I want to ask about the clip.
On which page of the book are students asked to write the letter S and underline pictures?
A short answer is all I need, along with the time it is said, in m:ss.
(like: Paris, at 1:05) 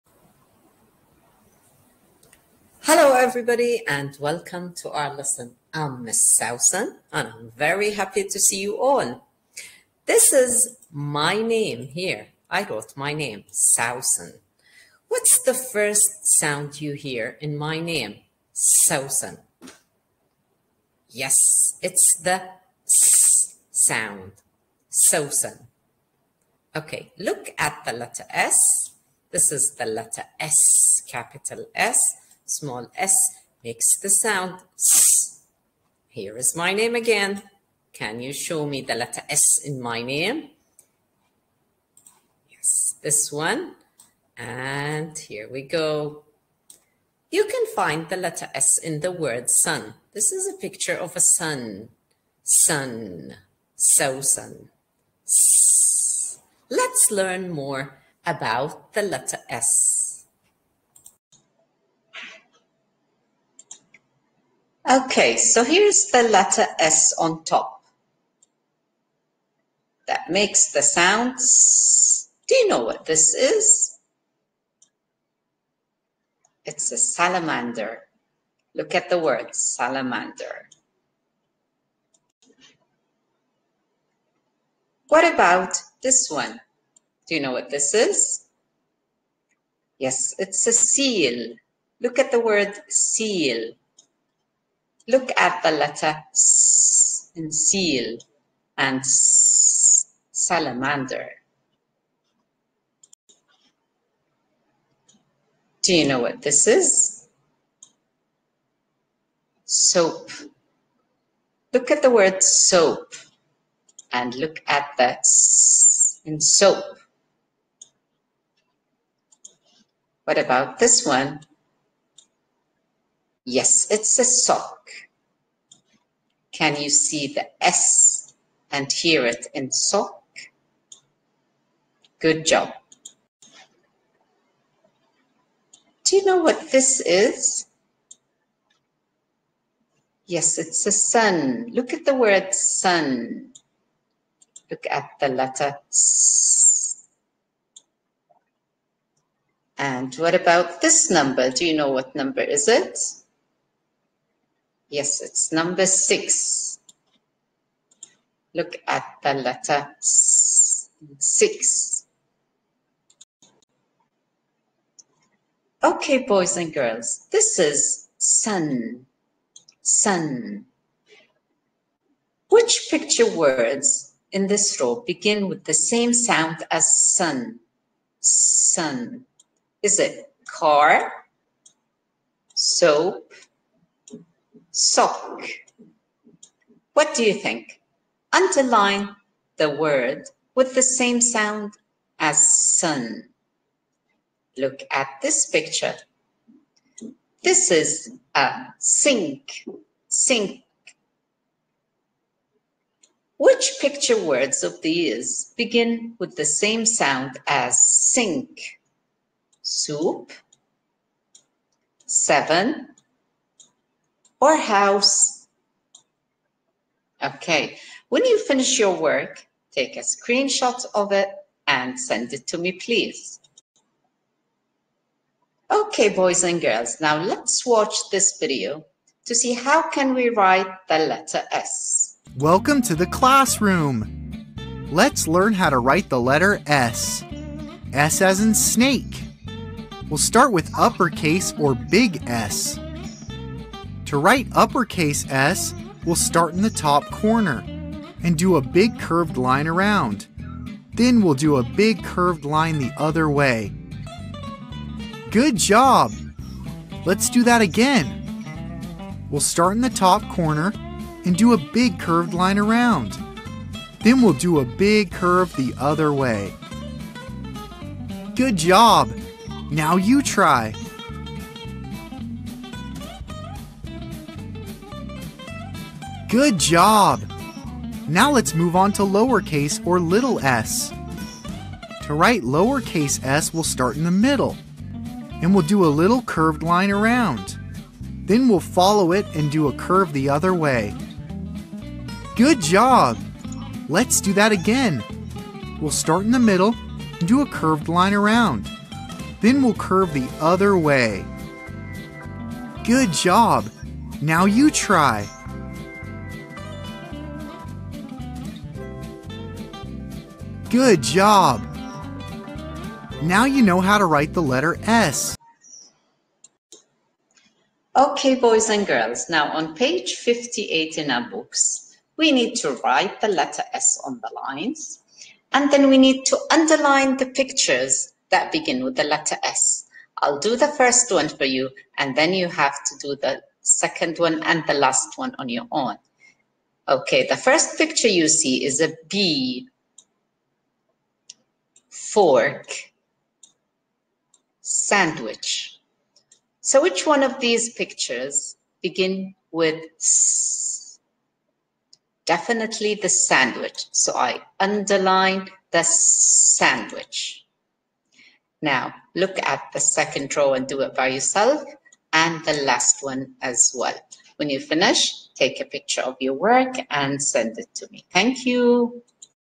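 58, at 5:20.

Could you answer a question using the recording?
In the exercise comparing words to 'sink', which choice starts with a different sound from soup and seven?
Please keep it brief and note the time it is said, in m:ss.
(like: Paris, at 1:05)
House, at 3:34.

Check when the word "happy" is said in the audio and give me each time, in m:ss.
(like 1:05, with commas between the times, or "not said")
0:07.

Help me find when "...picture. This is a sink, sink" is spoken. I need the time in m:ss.
3:15.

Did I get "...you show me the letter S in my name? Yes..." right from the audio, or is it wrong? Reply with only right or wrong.
right.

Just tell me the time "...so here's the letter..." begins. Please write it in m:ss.
1:05.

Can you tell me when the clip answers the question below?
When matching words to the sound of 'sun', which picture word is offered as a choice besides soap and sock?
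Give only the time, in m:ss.
3:00.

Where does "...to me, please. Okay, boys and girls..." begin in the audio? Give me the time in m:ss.
3:42.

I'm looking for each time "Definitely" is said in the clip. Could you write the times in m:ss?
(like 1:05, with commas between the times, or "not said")
5:52.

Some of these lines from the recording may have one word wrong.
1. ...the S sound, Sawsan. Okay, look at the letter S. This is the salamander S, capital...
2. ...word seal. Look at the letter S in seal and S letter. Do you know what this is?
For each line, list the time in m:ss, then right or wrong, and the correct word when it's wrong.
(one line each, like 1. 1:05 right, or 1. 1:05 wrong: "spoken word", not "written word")
1. 0:22 wrong: "letter", not "salamander"
2. 1:32 wrong: "salamander", not "letter".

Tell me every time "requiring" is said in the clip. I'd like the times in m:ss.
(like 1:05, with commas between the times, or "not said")
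not said.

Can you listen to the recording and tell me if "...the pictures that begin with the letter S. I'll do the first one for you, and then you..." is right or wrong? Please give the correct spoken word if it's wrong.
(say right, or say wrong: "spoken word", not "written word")
right.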